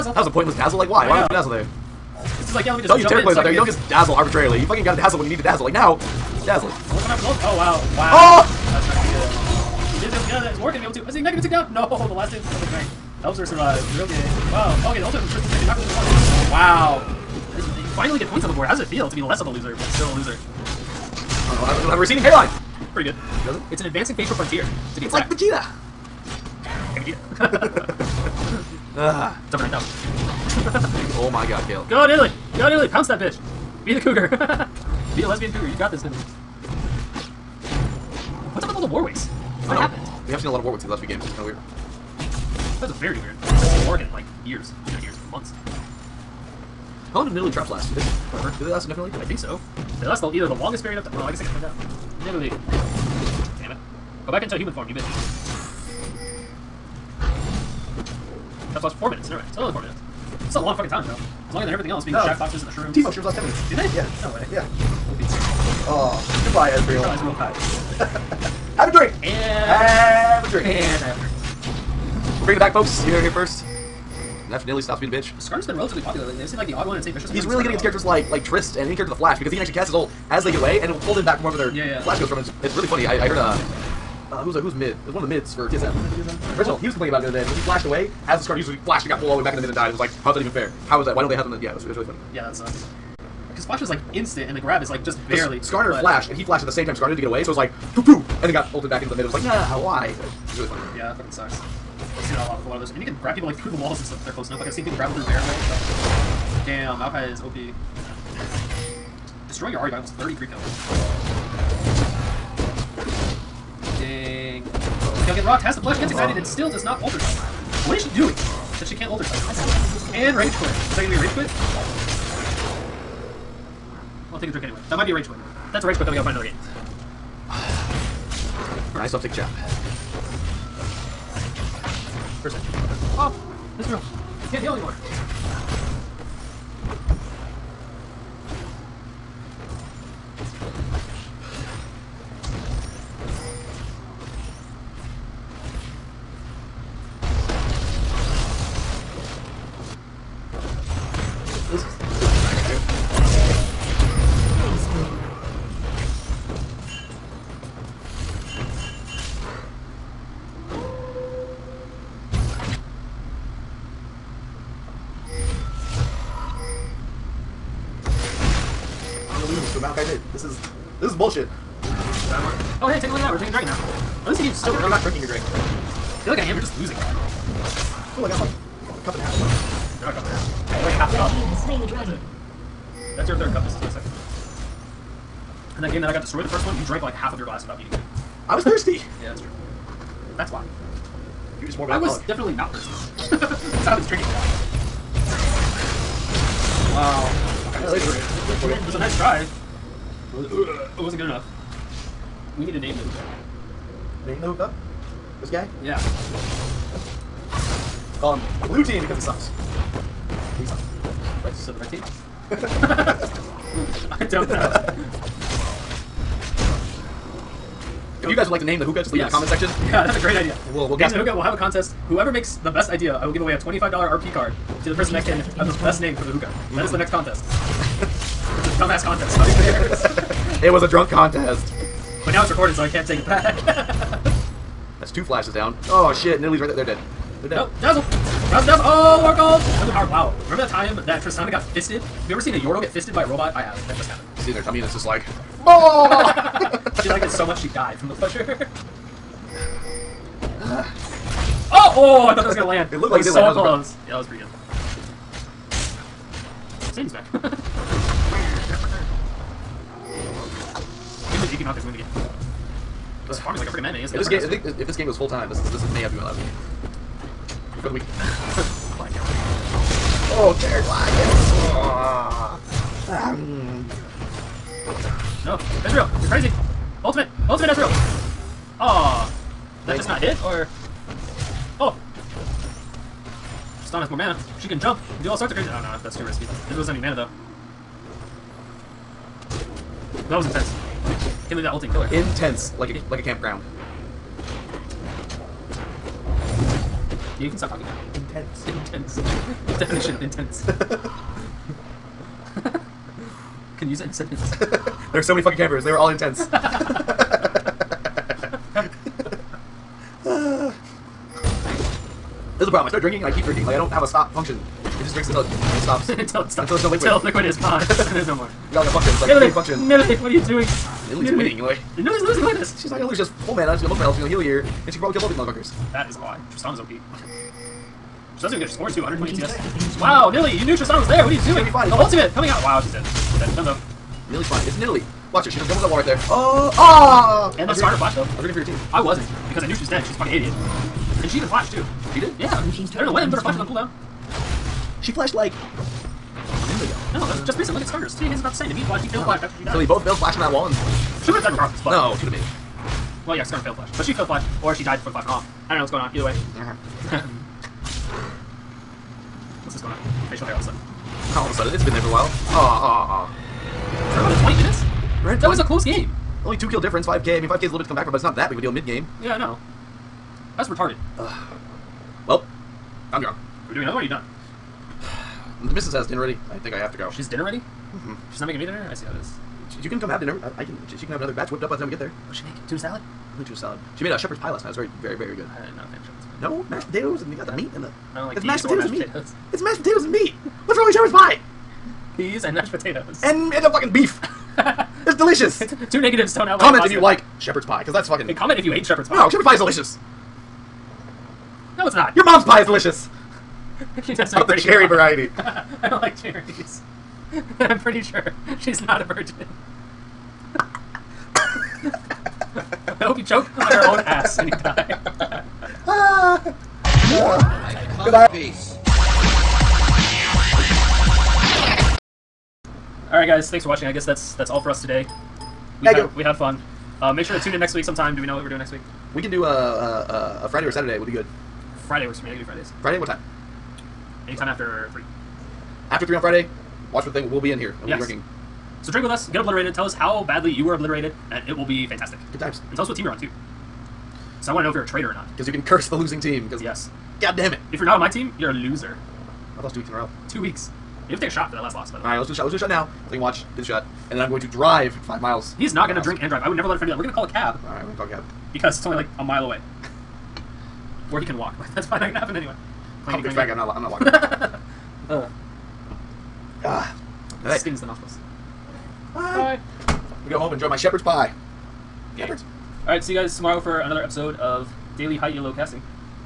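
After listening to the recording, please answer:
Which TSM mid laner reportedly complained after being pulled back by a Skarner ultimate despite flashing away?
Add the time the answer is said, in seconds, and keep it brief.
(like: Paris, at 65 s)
Reginald, at 86 s.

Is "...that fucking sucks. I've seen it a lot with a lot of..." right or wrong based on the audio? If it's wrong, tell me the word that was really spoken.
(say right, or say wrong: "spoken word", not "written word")
right.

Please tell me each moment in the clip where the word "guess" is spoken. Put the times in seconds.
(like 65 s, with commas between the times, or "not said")
51 s, 423 s.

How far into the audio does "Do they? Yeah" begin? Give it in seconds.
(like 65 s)
63 s.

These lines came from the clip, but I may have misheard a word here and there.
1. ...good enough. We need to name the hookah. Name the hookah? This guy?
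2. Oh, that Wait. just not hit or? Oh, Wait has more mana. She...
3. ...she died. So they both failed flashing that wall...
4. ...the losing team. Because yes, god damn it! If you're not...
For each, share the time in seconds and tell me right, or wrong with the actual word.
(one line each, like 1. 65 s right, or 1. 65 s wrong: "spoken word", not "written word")
1. 201 s right
2. 278 s wrong: "Stun", not "Wait"
3. 349 s right
4. 445 s right.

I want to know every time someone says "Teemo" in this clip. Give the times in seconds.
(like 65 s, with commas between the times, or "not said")
62 s.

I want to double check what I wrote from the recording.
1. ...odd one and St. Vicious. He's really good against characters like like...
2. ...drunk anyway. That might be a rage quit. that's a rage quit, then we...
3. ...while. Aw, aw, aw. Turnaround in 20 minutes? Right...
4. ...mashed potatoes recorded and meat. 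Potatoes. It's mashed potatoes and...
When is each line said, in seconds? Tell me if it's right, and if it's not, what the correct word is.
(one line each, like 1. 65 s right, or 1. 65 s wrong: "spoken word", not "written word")
1. 76 s right
2. 124 s wrong: "drink", not "drunk"
3. 362 s right
4. 388 s wrong: "mashed", not "recorded".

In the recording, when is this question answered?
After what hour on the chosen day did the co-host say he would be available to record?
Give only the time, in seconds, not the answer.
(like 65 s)
434 s.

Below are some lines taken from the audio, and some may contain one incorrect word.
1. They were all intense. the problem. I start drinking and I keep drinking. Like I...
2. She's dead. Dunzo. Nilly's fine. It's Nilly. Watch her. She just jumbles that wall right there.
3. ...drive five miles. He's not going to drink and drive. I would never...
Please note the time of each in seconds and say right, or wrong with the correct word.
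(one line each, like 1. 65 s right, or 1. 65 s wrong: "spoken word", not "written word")
1. 305 s right
2. 333 s right
3. 454 s right.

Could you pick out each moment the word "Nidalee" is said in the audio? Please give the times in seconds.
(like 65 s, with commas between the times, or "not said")
47 s, 52 s, 236 s.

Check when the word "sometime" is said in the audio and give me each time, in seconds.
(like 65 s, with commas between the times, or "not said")
427 s.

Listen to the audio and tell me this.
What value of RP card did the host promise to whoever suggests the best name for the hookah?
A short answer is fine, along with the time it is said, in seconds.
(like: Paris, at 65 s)
$25, at 223 s.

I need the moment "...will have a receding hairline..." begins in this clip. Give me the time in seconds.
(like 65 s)
21 s.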